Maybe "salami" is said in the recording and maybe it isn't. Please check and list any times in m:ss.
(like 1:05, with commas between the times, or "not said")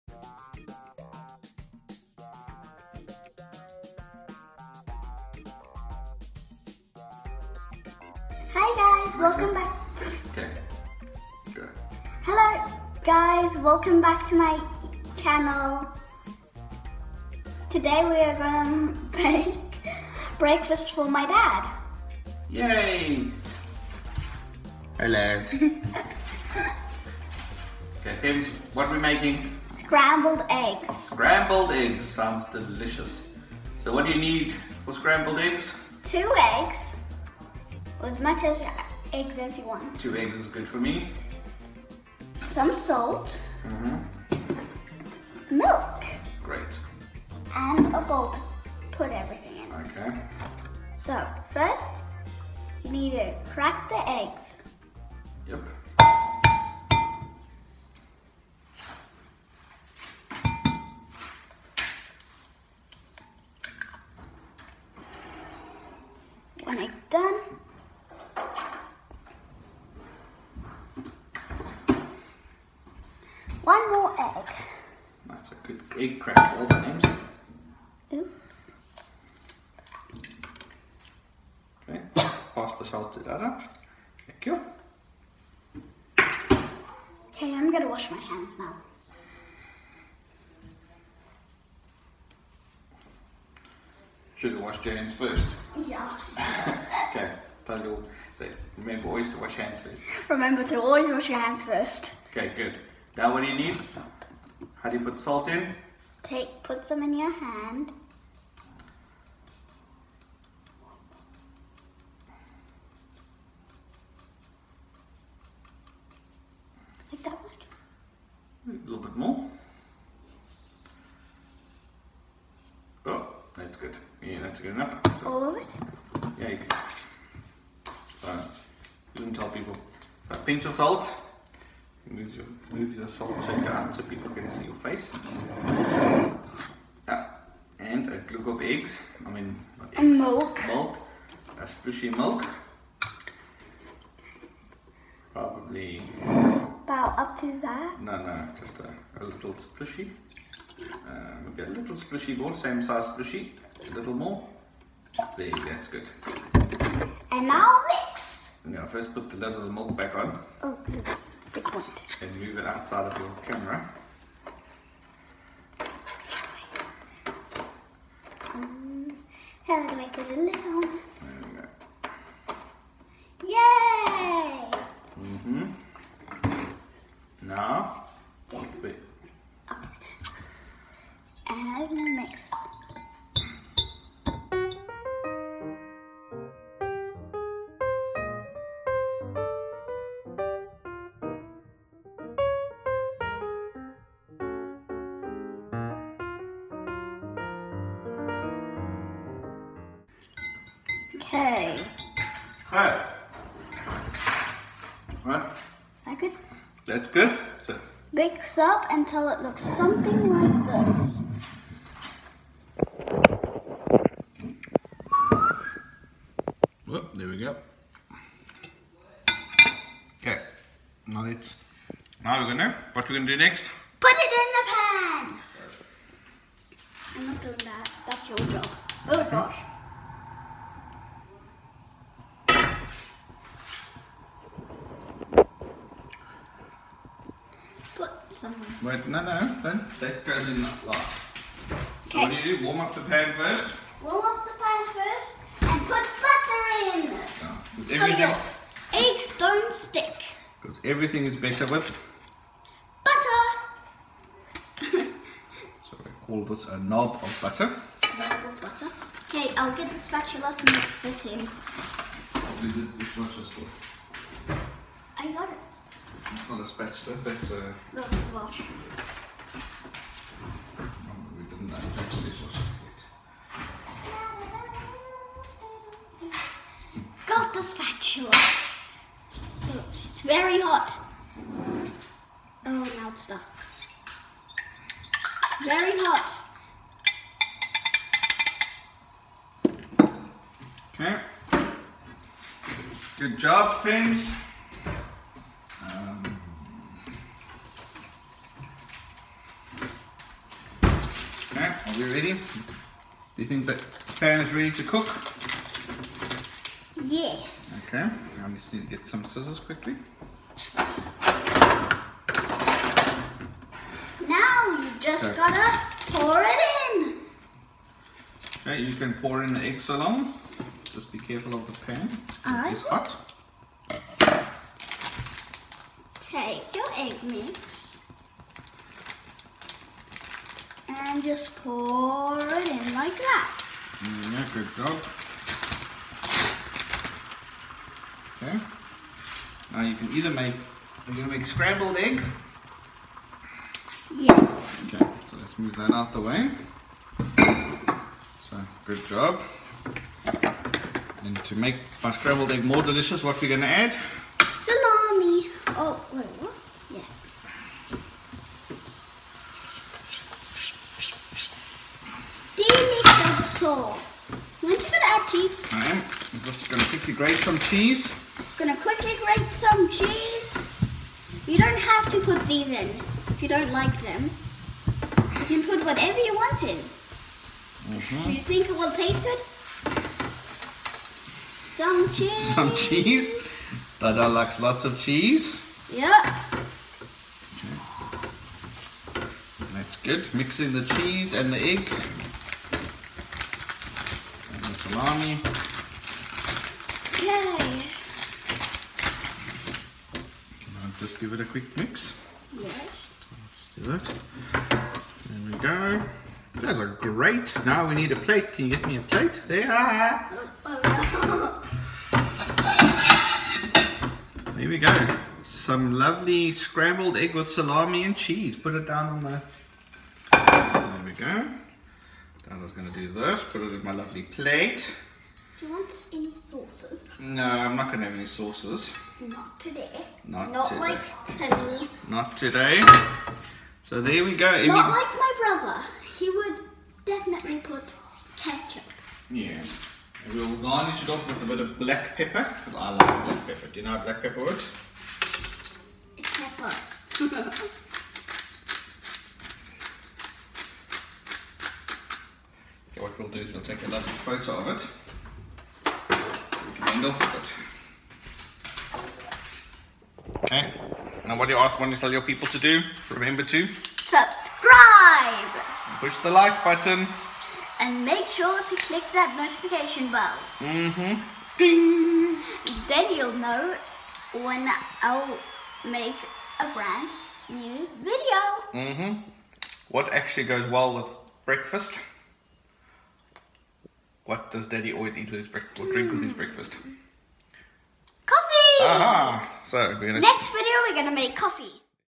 5:54, 6:57.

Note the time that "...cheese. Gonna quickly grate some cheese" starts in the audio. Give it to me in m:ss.
6:07.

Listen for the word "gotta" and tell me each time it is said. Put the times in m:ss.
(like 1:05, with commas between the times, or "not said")
5:15.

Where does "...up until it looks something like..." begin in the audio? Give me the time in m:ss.
3:28.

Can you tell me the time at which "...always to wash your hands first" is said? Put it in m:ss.
1:39.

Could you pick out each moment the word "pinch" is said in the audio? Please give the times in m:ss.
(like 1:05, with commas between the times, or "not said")
2:10.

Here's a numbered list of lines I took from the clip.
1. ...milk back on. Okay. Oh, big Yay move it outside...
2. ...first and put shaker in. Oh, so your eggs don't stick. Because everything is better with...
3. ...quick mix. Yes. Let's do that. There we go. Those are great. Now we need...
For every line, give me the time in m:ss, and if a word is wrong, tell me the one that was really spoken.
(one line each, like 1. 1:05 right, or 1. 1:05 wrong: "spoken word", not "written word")
1. 2:39 wrong: "And", not "Yay"
2. 4:04 wrong: "butter", not "shaker"
3. 6:41 right.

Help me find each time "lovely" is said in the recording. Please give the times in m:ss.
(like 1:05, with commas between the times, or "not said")
6:55, 7:03, 7:33.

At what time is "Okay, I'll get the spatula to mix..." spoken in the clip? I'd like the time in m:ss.
4:19.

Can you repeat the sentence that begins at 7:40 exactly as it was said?
Okay, now what do you ask, want to tell your people to do?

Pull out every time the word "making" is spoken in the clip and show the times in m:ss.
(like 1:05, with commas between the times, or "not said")
0:28.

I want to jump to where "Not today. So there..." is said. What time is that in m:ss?
7:12.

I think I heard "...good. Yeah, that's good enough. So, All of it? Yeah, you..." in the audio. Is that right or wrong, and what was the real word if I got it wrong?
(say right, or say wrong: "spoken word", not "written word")
right.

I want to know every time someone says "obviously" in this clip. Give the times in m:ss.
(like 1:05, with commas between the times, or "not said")
not said.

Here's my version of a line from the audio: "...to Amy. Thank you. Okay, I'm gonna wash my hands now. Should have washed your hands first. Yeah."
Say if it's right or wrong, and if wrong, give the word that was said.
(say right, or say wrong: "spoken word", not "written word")
wrong: "Dada", not "Amy".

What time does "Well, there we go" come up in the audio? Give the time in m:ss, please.
3:36.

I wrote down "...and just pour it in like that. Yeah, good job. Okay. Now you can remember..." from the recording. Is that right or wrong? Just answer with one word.
wrong.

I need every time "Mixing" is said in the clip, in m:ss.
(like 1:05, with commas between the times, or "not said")
6:30.